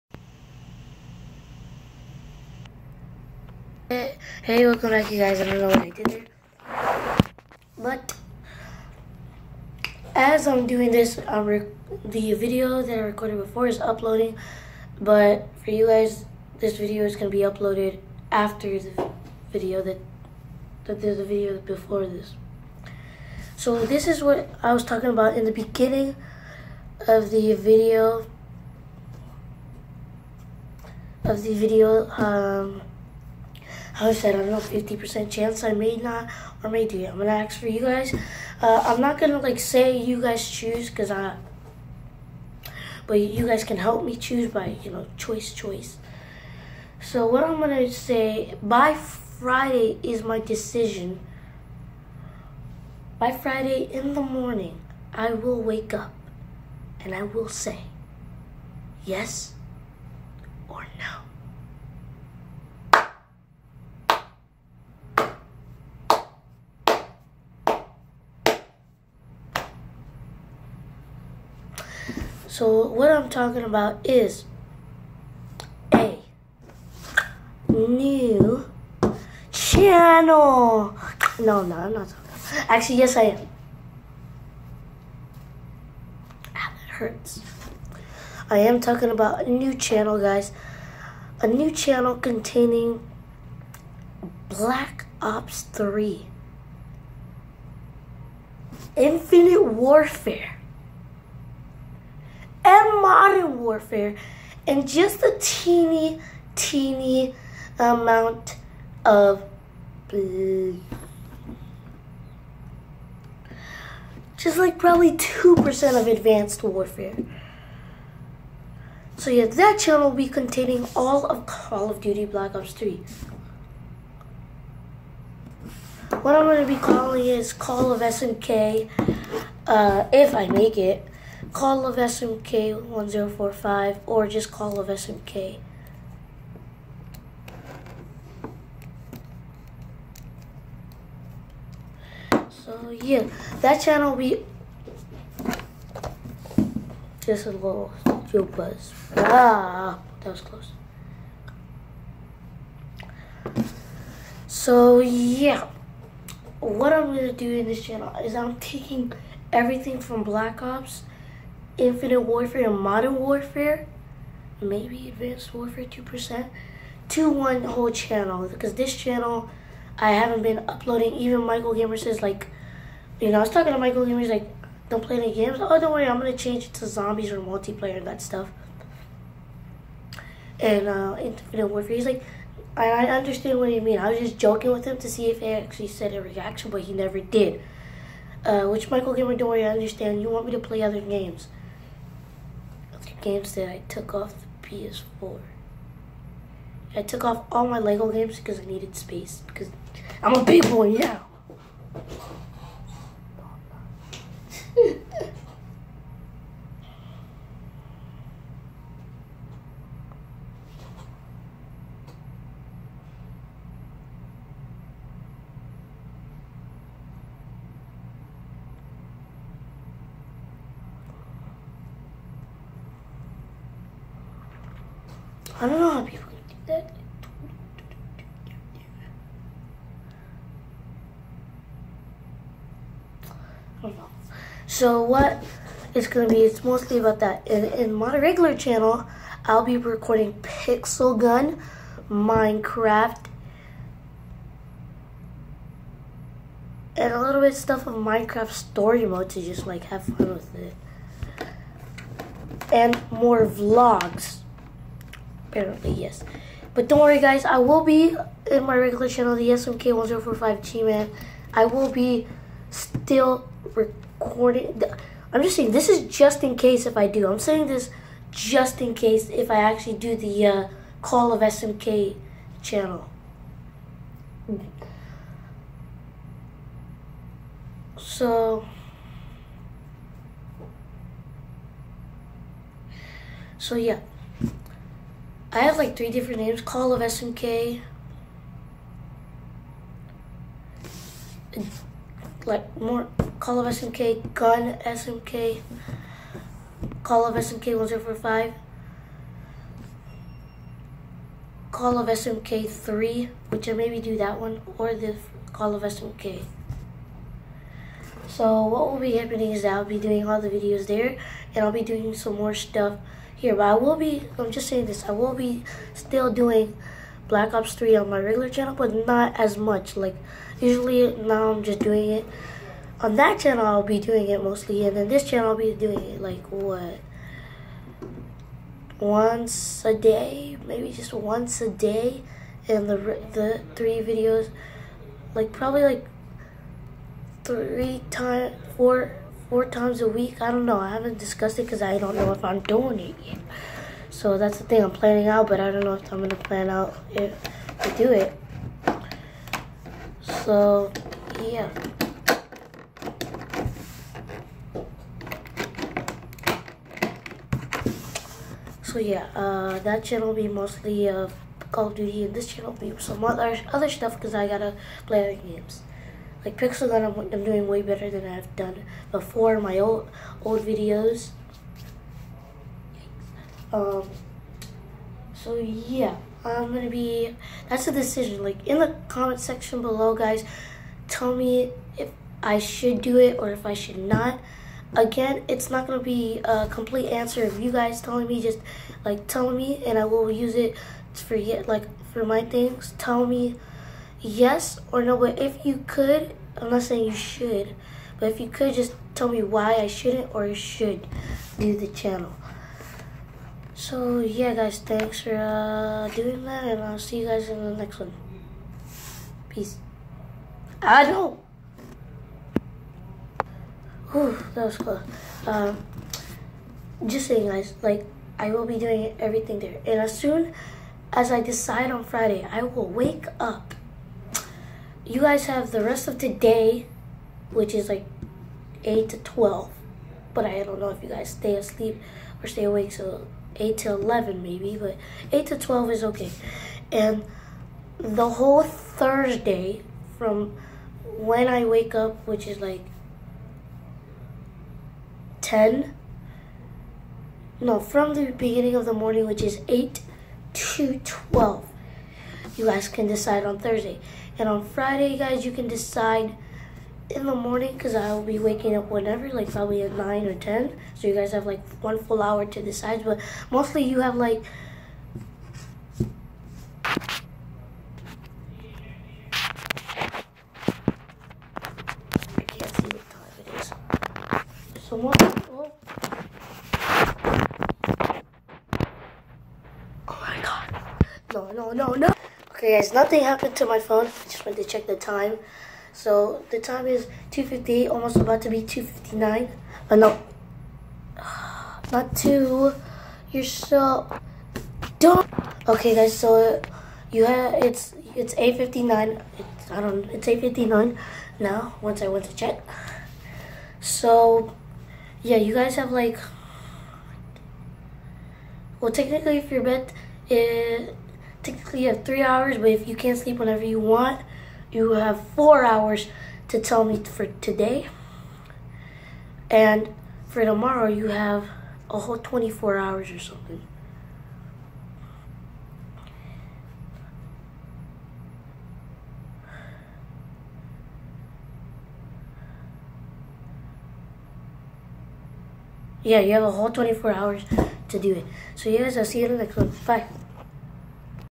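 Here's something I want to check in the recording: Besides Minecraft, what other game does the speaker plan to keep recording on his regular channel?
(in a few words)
Pixel Gun.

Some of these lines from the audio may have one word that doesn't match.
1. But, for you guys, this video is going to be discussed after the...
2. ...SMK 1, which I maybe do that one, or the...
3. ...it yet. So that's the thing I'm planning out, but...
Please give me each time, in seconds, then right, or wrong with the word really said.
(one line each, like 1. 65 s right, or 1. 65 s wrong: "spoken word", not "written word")
1. 15 s wrong: "uploaded", not "discussed"
2. 302 s wrong: "3", not "1"
3. 342 s right.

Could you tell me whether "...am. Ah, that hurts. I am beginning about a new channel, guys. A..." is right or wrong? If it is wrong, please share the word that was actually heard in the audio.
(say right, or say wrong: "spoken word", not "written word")
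wrong: "talking", not "beginning".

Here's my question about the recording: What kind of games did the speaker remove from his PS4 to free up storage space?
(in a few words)
Lego games.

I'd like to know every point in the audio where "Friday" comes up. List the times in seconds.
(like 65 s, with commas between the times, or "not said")
48 s, 53 s, 422 s, 454 s.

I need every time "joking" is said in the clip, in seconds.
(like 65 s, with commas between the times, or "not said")
184 s.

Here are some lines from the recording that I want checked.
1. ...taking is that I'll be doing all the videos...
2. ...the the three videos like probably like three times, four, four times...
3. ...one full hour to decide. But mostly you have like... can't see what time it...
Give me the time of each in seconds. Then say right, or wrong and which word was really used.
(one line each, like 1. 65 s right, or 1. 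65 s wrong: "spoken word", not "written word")
1. 309 s wrong: "happening", not "taking"
2. 332 s right
3. 461 s right.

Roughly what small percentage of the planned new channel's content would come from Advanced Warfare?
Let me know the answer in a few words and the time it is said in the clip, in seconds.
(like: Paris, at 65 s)
2%, at 114 s.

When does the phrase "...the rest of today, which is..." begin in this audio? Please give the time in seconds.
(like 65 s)
425 s.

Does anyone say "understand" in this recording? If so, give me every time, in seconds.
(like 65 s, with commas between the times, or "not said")
183 s, 189 s.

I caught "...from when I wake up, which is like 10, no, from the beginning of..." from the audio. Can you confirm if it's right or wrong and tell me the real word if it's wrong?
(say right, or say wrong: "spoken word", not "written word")
right.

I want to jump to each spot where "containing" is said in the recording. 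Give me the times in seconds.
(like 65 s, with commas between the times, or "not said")
92 s, 120 s.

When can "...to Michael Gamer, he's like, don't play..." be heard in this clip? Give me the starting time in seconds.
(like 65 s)
173 s.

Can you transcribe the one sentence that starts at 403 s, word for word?
So yeah guys, thanks for uh, doing that and I'll see you guys in the next one.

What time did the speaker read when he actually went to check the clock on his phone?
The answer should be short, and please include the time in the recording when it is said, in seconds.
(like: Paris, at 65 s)
8:59, at 500 s.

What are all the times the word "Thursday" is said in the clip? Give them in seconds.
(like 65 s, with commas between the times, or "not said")
438 s, 453 s.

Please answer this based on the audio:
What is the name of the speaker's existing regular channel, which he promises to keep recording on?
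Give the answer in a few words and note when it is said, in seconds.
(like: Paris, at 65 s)
SMK1045G Man, at 259 s.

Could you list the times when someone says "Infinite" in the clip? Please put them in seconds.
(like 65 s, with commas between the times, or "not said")
98 s, 161 s, 181 s.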